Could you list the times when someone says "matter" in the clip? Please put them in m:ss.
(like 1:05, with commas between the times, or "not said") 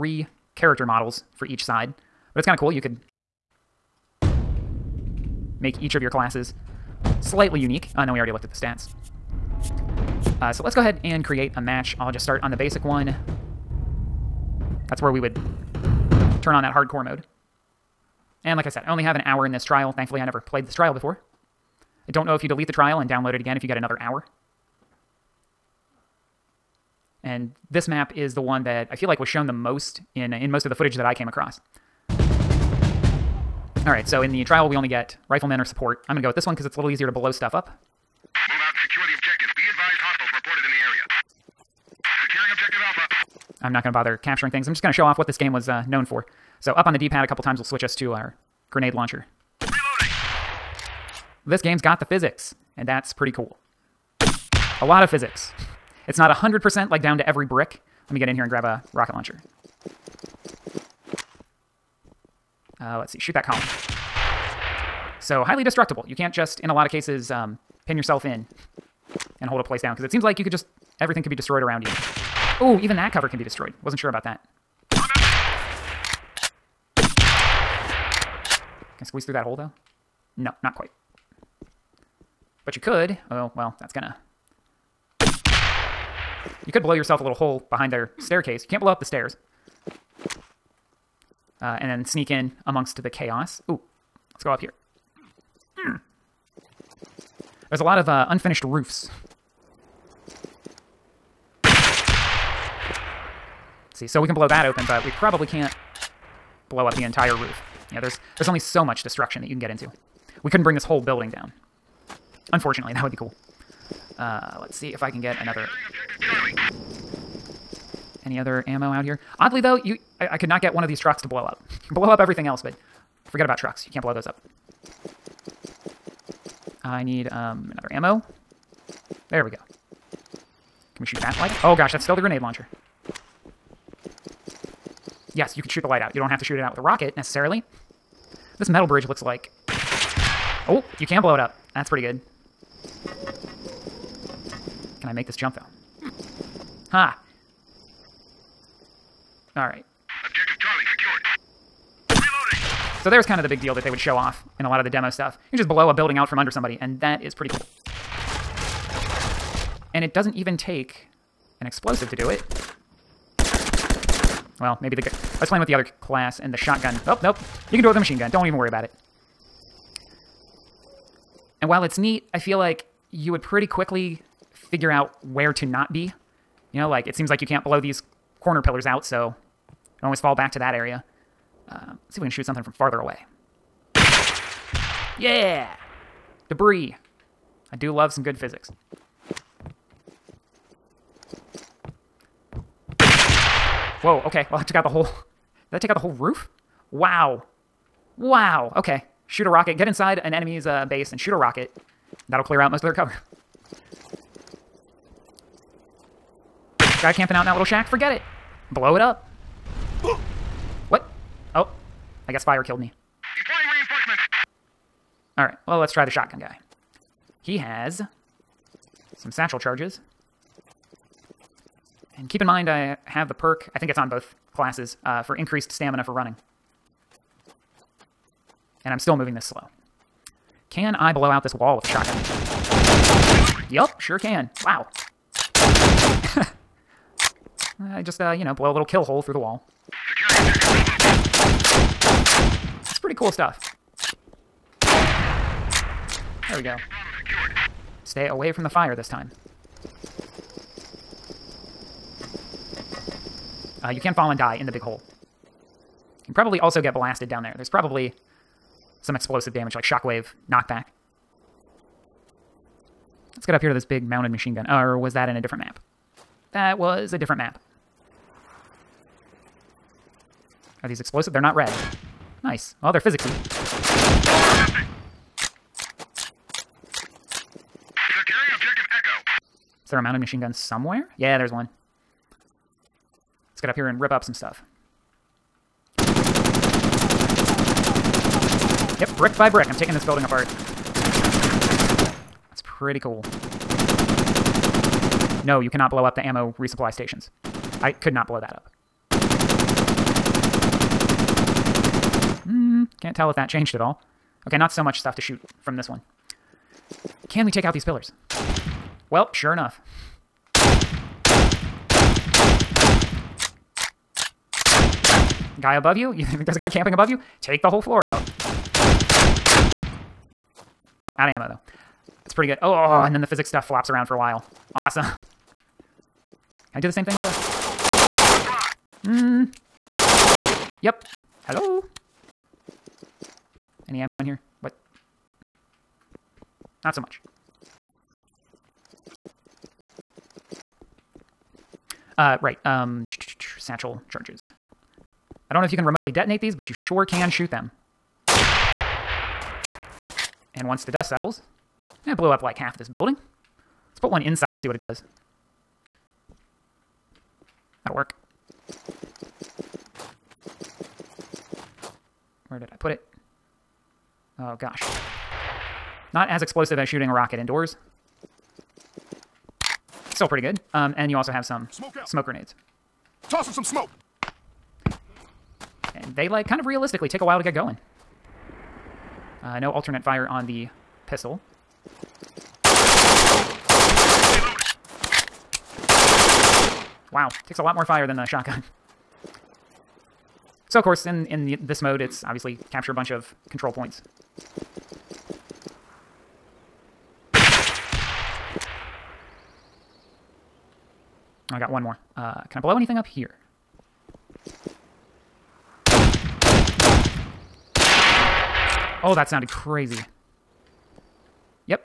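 not said.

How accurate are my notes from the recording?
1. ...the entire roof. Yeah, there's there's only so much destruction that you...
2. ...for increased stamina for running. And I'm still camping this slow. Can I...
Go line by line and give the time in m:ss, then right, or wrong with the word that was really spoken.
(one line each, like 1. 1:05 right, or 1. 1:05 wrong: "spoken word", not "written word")
1. 1:46 right
2. 3:45 wrong: "moving", not "camping".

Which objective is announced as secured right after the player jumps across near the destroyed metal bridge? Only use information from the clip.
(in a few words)
Charlie.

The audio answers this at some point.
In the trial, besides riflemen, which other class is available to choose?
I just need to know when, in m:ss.
0:35.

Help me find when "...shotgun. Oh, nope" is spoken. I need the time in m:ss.
2:46.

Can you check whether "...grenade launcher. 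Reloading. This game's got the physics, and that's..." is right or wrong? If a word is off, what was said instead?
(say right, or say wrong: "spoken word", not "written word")
right.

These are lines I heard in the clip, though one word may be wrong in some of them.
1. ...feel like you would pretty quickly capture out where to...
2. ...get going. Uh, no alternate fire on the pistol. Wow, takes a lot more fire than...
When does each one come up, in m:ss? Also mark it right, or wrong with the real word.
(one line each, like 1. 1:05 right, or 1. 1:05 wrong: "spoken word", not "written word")
1. 2:52 wrong: "figure", not "capture"
2. 6:17 right.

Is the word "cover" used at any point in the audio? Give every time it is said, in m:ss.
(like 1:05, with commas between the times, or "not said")
1:13, 3:22.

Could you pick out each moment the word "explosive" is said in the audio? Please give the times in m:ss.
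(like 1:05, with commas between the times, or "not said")
2:41, 4:19, 4:30, 6:06.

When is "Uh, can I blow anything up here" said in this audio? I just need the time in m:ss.
6:42.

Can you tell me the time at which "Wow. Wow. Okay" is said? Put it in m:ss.
3:16.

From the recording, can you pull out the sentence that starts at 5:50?
And once the dust settles, eh, it blew up like half this building.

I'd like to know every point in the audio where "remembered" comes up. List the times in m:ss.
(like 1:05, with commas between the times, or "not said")
not said.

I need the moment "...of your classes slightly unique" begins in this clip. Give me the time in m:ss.
0:05.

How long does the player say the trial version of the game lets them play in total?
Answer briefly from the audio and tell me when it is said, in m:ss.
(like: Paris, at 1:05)
1 hour, at 0:19.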